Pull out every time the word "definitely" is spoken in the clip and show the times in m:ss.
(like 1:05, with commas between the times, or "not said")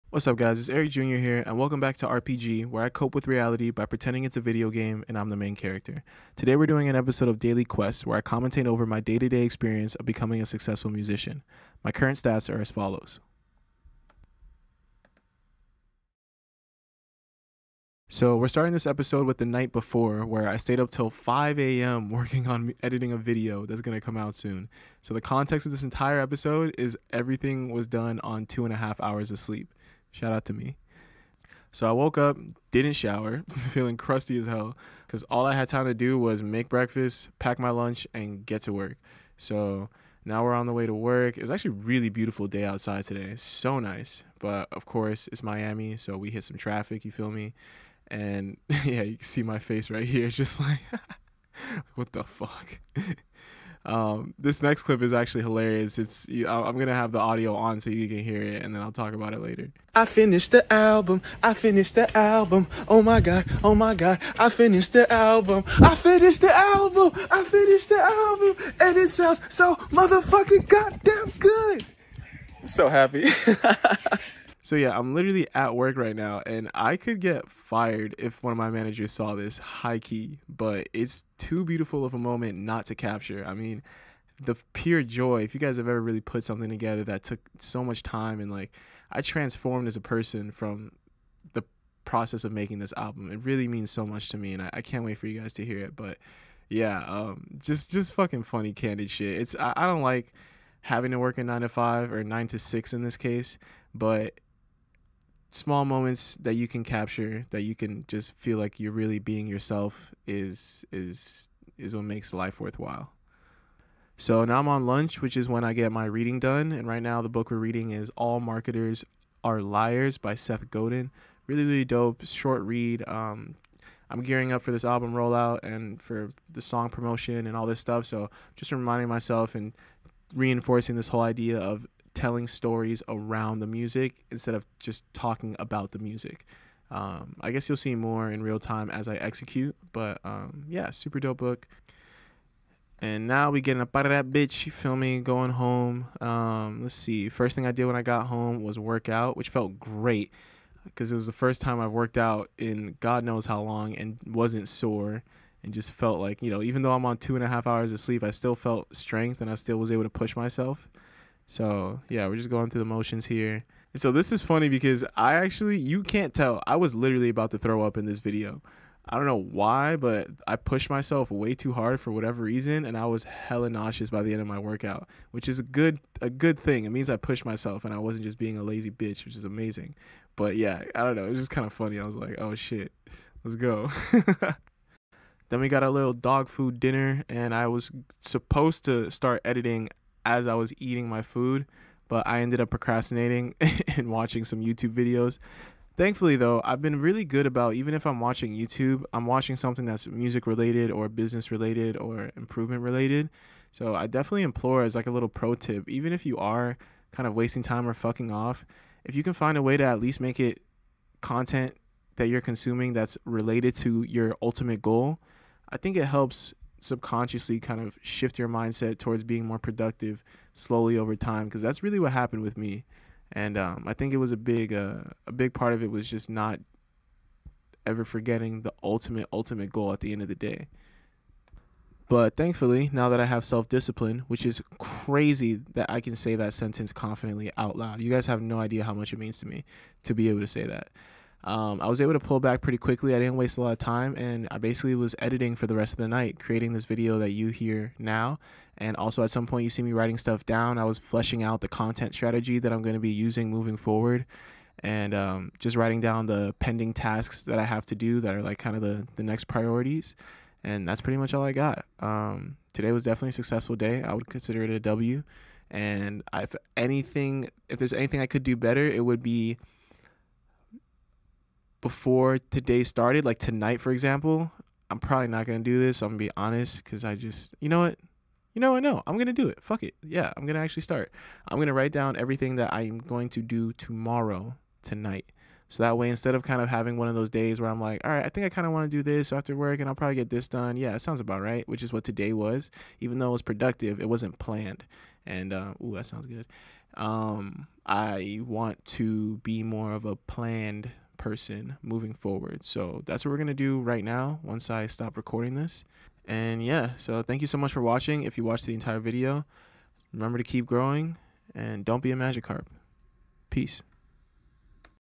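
3:24, 4:23.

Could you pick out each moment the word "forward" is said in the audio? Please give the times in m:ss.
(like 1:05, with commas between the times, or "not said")
4:13, 5:02.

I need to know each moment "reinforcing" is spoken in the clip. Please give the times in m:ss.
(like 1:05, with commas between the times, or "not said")
2:10.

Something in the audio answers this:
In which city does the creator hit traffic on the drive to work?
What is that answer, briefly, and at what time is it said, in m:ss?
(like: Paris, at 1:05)
Miami, at 0:45.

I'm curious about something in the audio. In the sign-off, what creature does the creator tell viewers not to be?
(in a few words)
Magikarp.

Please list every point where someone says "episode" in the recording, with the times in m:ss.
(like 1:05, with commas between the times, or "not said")
0:06, 0:18, 0:26.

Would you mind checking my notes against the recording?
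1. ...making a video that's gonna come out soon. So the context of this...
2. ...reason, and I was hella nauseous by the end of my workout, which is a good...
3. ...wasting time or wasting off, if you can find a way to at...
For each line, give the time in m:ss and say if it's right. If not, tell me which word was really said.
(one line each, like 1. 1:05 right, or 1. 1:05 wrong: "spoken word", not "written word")
1. 0:22 wrong: "editing", not "making"
2. 2:52 right
3. 3:27 wrong: "fucking", not "wasting".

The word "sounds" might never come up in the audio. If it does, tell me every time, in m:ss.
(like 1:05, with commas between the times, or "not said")
1:09, 4:50, 4:56.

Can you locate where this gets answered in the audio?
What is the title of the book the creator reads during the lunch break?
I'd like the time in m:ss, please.
1:58.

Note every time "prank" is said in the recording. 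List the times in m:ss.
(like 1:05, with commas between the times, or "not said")
not said.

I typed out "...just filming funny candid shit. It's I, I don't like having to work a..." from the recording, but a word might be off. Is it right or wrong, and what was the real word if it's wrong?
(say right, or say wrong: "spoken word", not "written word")
wrong: "fucking", not "filming".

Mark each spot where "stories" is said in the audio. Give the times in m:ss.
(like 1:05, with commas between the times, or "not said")
2:12.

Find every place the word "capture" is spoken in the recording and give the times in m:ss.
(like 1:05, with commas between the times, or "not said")
1:22, 1:46.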